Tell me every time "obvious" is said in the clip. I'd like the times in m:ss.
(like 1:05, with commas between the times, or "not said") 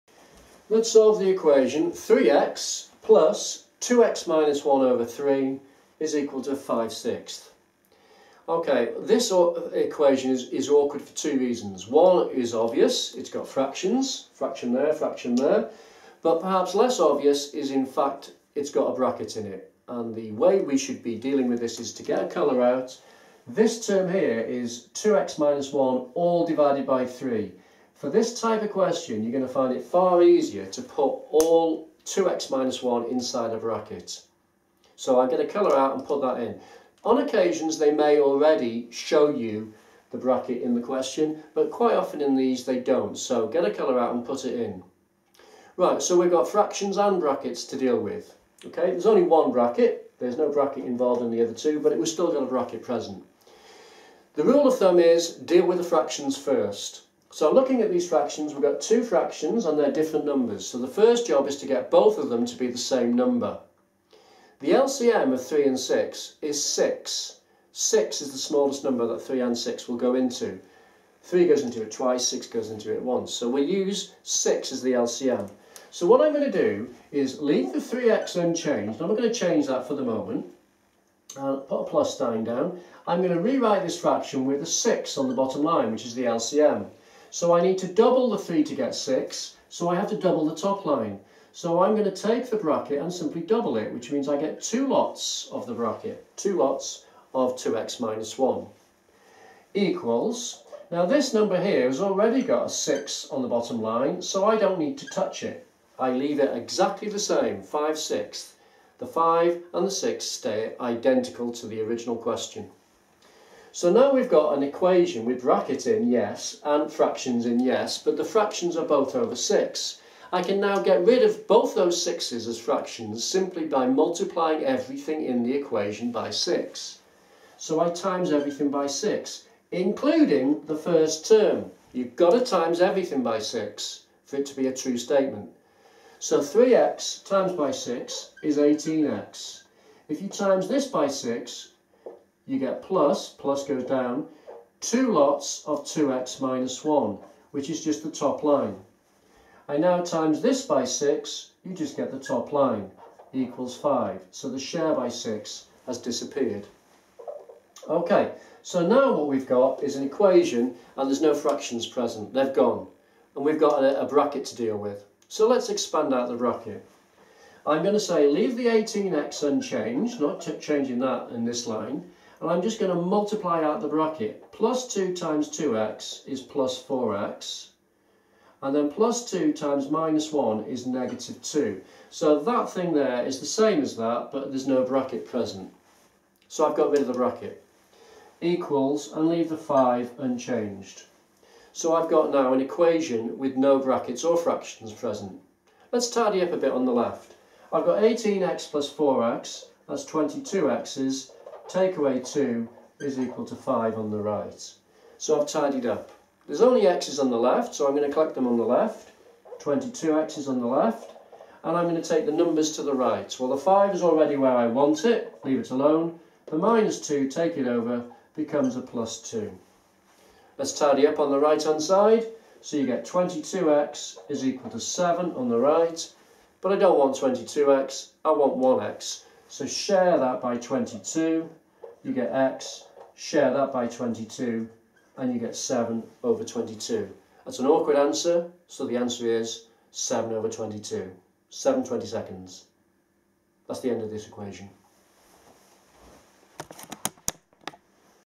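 0:12, 0:17.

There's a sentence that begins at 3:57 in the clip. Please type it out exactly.
That's an awkward answer, so the answer is 7 over 22.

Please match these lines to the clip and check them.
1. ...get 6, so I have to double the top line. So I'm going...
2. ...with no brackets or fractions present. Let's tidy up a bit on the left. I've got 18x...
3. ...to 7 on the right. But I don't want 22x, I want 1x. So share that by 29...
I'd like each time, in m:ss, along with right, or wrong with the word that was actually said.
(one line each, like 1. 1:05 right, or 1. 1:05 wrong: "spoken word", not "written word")
1. 1:28 right
2. 3:13 right
3. 3:44 wrong: "22", not "29".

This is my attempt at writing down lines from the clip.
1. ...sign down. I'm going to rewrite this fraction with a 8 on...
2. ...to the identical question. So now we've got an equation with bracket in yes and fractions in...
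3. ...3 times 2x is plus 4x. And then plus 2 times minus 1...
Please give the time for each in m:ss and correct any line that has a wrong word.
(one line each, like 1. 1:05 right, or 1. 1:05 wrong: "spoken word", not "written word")
1. 1:22 wrong: "6", not "8"
2. 1:51 wrong: "original", not "identical"
3. 2:54 wrong: "2", not "3".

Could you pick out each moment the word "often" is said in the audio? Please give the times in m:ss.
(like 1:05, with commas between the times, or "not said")
0:41.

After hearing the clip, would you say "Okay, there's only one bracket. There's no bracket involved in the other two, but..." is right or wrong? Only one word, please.
right.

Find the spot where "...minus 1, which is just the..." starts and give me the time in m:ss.
2:26.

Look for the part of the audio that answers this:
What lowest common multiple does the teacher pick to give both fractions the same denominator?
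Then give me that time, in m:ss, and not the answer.
1:04.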